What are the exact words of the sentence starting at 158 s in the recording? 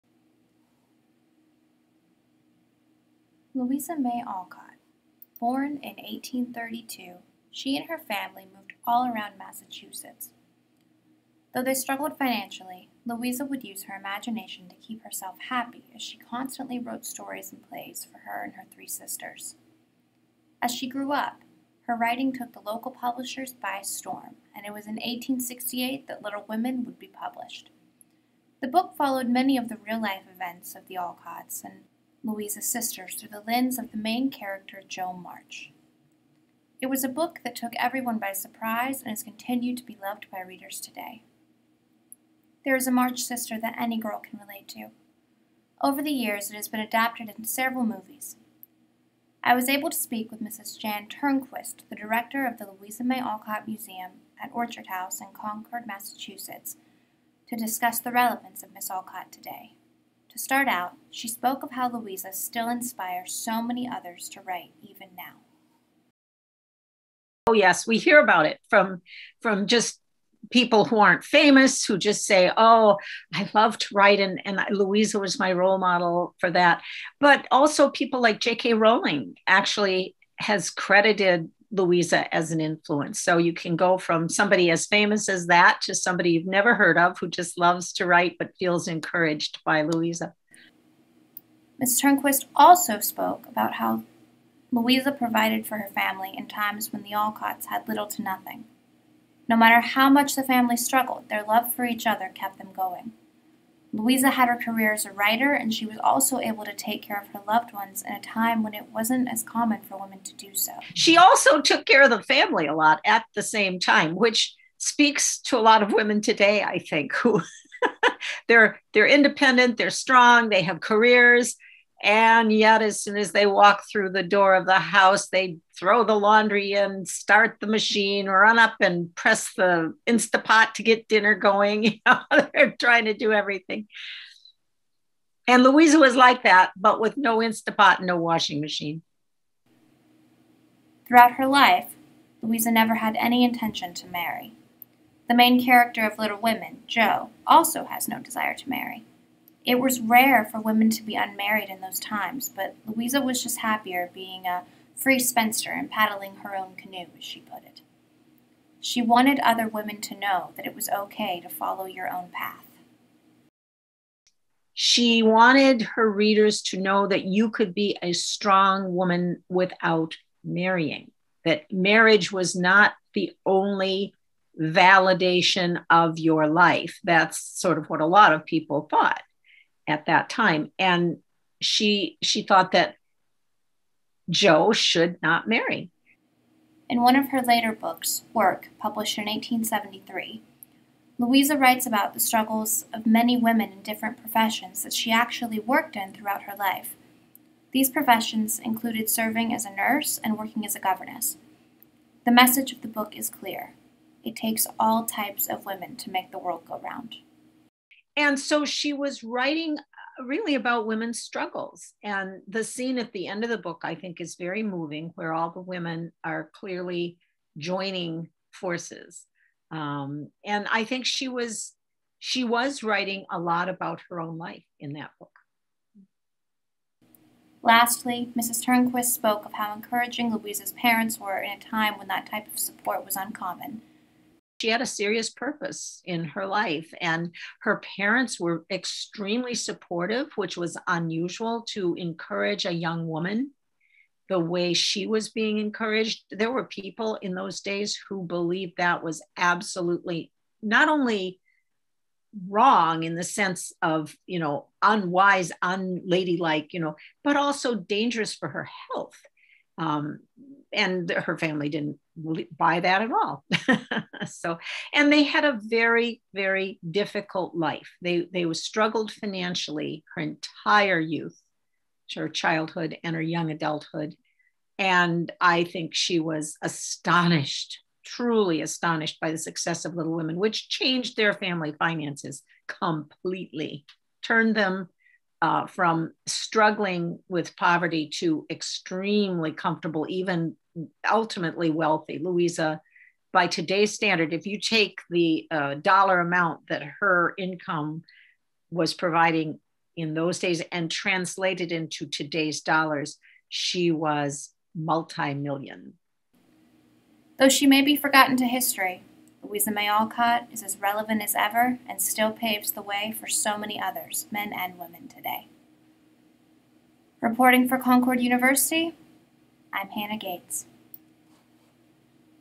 She wanted other women to know that it was okay to follow your own path.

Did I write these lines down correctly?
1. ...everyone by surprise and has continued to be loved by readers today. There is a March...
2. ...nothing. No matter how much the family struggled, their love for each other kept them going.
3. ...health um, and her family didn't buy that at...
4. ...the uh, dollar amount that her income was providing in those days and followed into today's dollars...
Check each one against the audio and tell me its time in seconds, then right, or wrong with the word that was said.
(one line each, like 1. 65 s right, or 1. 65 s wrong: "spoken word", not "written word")
1. 37 s right
2. 98 s right
3. 258 s right
4. 295 s wrong: "translated", not "followed".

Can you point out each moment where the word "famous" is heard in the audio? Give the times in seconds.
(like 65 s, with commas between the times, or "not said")
71 s, 84 s.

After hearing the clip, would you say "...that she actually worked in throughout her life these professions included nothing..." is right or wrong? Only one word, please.
wrong.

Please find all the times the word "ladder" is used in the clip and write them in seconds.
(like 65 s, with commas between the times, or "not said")
not said.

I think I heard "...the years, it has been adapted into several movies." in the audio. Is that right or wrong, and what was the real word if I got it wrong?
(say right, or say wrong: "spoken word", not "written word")
right.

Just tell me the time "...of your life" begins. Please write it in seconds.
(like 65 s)
175 s.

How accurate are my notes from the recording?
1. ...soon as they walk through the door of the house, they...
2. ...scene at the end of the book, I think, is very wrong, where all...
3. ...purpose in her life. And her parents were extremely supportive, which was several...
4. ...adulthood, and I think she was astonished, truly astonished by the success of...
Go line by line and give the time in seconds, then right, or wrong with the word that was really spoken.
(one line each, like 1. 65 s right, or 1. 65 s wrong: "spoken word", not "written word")
1. 123 s right
2. 212 s wrong: "moving", not "wrong"
3. 235 s wrong: "unusual", not "several"
4. 273 s right.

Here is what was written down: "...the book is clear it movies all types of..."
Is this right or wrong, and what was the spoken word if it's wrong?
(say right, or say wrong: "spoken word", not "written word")
wrong: "takes", not "movies".